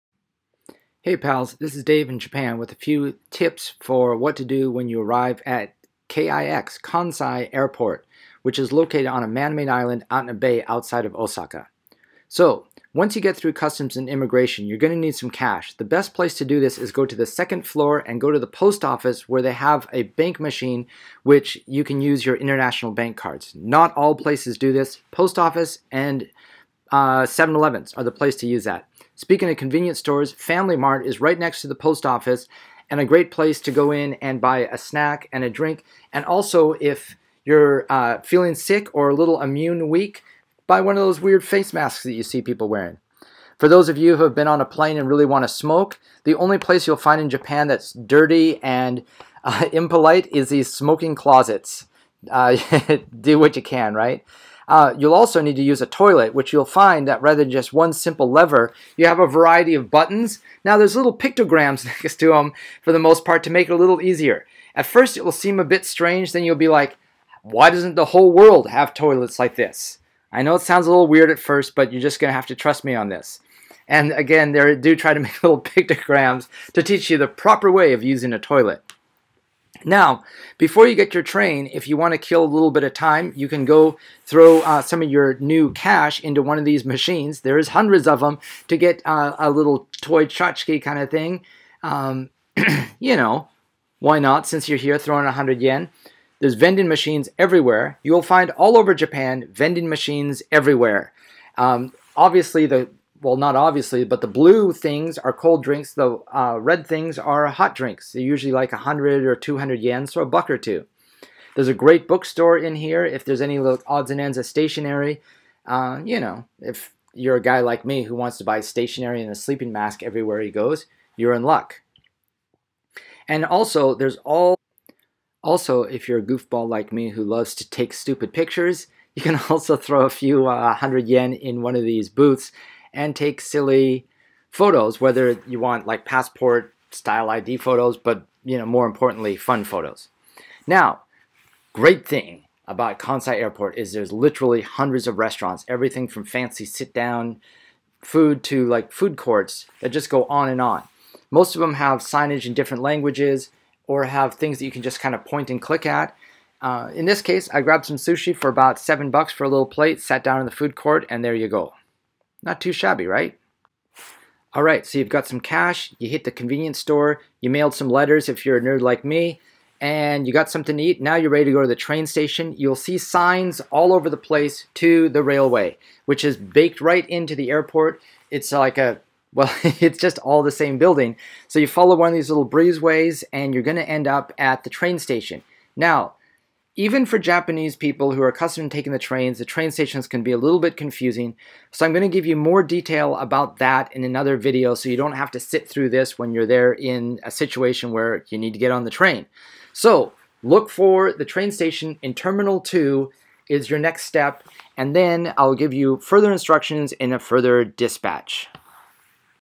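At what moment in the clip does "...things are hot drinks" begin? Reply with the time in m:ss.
1:46.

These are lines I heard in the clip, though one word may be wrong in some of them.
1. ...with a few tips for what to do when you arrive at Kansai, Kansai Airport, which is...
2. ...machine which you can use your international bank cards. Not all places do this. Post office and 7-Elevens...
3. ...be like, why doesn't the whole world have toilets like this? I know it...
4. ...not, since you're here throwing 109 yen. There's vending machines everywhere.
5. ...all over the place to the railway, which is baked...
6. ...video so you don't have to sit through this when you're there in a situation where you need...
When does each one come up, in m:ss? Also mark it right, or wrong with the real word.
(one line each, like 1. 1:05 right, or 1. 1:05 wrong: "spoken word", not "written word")
1. 0:02 wrong: "KIX", not "Kansai"
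2. 0:20 right
3. 1:06 right
4. 1:34 wrong: "100", not "109"
5. 2:53 right
6. 3:14 right.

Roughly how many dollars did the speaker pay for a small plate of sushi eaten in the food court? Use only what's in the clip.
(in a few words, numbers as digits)
7.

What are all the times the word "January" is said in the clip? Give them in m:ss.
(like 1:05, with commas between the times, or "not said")
not said.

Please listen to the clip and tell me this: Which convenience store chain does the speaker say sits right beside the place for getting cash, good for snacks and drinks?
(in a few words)
Family Mart.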